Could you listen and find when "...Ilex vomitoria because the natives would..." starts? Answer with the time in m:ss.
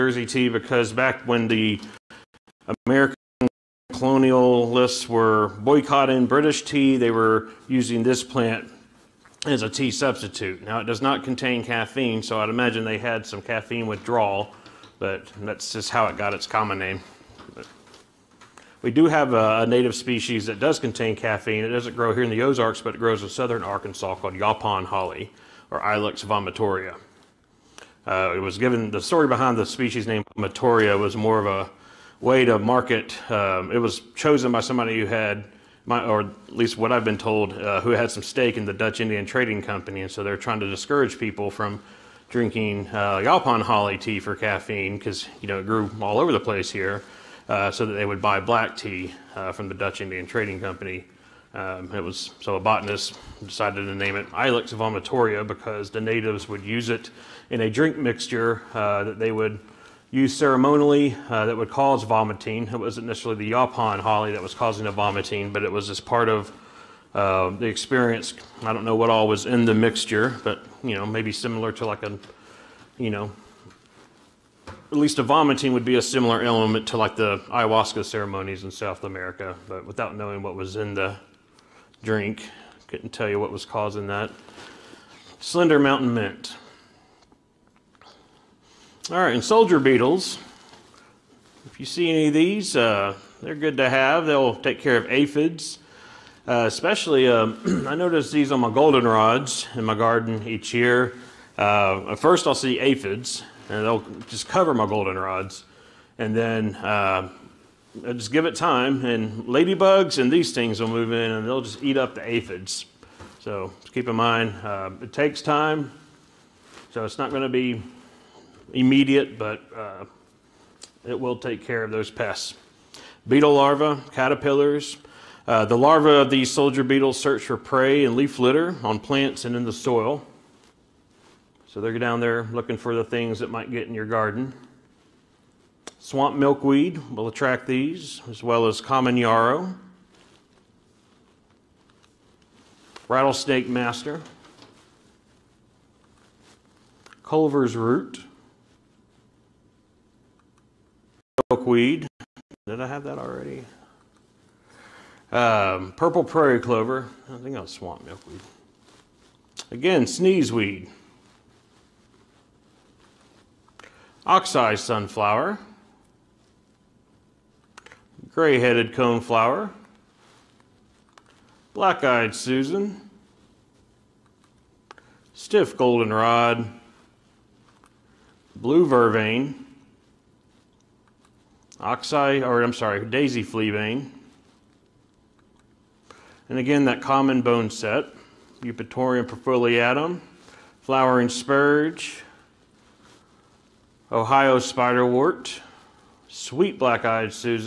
0:54.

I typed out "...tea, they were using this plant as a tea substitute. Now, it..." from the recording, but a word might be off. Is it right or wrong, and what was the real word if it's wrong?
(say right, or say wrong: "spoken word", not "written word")
right.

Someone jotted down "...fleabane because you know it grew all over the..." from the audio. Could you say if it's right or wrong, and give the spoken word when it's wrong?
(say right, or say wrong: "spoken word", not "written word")
wrong: "caffeine", not "fleabane".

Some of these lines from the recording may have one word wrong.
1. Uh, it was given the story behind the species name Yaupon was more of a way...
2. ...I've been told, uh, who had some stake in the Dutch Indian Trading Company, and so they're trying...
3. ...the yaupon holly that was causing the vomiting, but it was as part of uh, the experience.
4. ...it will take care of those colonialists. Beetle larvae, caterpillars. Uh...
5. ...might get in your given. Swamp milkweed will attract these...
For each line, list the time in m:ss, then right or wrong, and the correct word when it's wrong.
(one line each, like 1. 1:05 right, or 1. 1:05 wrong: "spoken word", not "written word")
1. 0:28 wrong: "Matoria", not "Yaupon"
2. 0:36 right
3. 1:03 right
4. 2:01 wrong: "pests", not "colonialists"
5. 2:13 wrong: "garden", not "given".